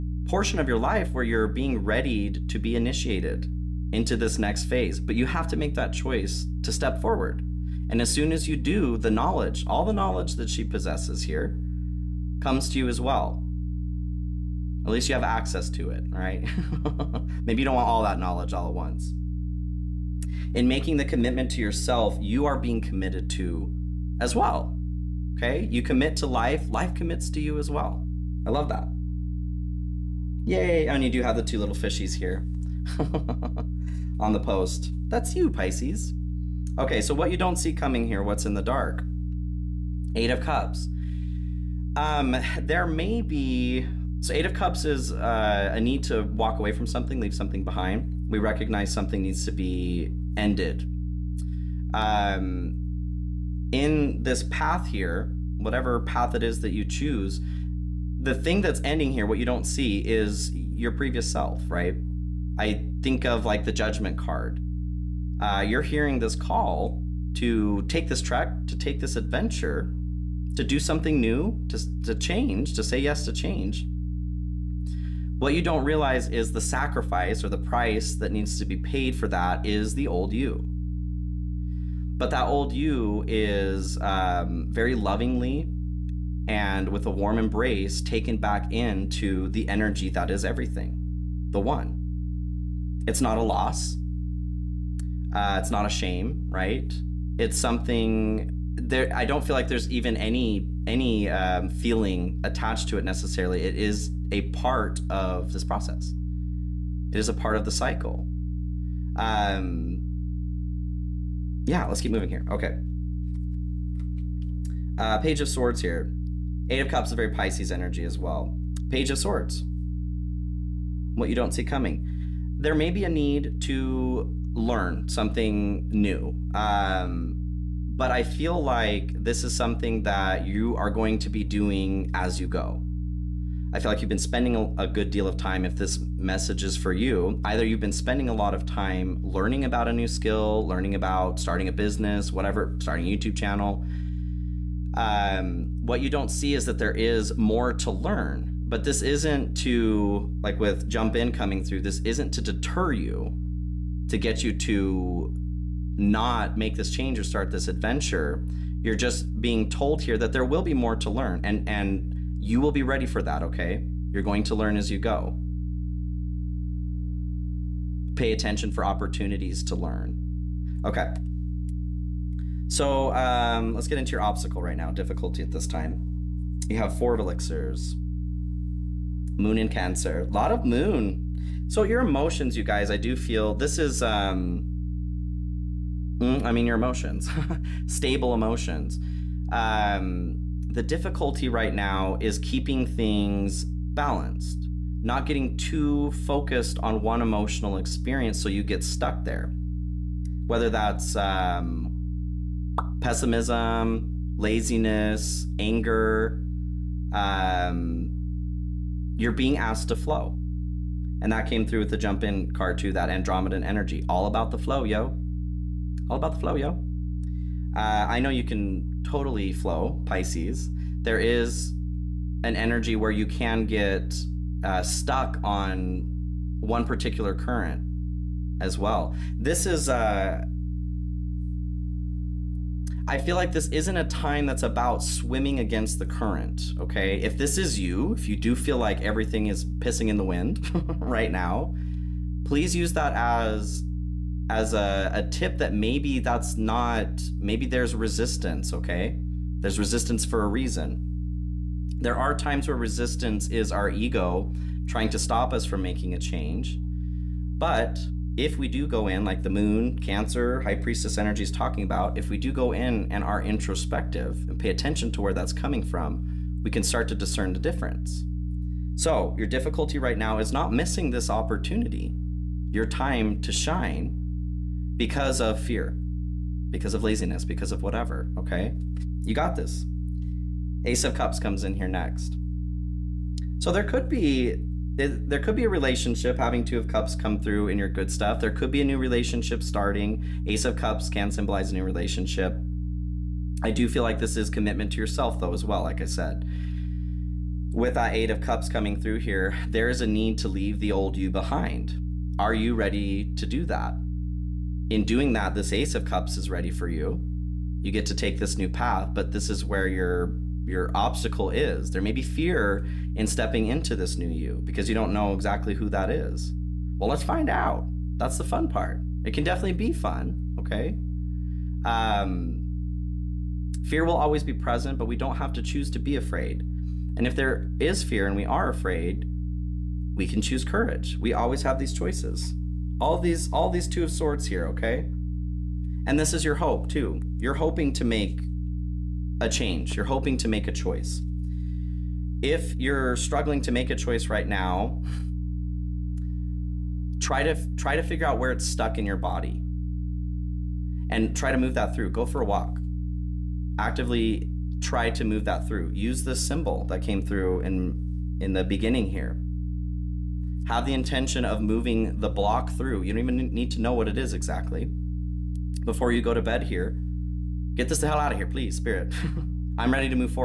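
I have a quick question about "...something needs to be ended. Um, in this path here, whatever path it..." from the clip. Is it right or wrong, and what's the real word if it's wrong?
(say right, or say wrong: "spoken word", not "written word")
right.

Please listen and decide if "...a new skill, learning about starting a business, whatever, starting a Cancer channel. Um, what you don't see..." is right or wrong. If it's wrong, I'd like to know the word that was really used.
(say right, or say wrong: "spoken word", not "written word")
wrong: "YouTube", not "Cancer".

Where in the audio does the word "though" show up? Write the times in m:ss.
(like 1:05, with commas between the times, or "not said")
4:55.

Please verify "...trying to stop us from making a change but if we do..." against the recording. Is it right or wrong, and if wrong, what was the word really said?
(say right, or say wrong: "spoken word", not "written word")
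right.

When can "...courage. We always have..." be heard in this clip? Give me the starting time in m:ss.
5:30.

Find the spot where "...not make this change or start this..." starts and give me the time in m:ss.
2:35.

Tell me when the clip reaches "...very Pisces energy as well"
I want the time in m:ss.
1:57.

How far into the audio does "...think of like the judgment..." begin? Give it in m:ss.
1:02.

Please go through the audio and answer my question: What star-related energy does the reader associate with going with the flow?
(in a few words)
Andromedan.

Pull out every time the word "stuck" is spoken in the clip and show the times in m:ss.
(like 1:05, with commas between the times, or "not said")
3:18, 3:44, 5:48.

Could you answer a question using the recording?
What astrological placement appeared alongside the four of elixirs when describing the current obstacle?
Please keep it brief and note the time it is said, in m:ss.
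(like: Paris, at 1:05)
Moon in Cancer, at 2:59.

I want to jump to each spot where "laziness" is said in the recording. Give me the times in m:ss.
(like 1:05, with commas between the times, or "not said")
3:24, 4:37.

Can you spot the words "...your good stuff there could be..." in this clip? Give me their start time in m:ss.
4:47.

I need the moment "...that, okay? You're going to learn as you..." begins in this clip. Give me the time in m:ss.
2:43.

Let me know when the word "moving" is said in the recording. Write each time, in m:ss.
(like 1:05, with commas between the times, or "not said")
1:52, 6:01.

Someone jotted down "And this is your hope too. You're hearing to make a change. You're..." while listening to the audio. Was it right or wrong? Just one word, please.
wrong.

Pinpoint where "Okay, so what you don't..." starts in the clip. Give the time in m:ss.
0:36.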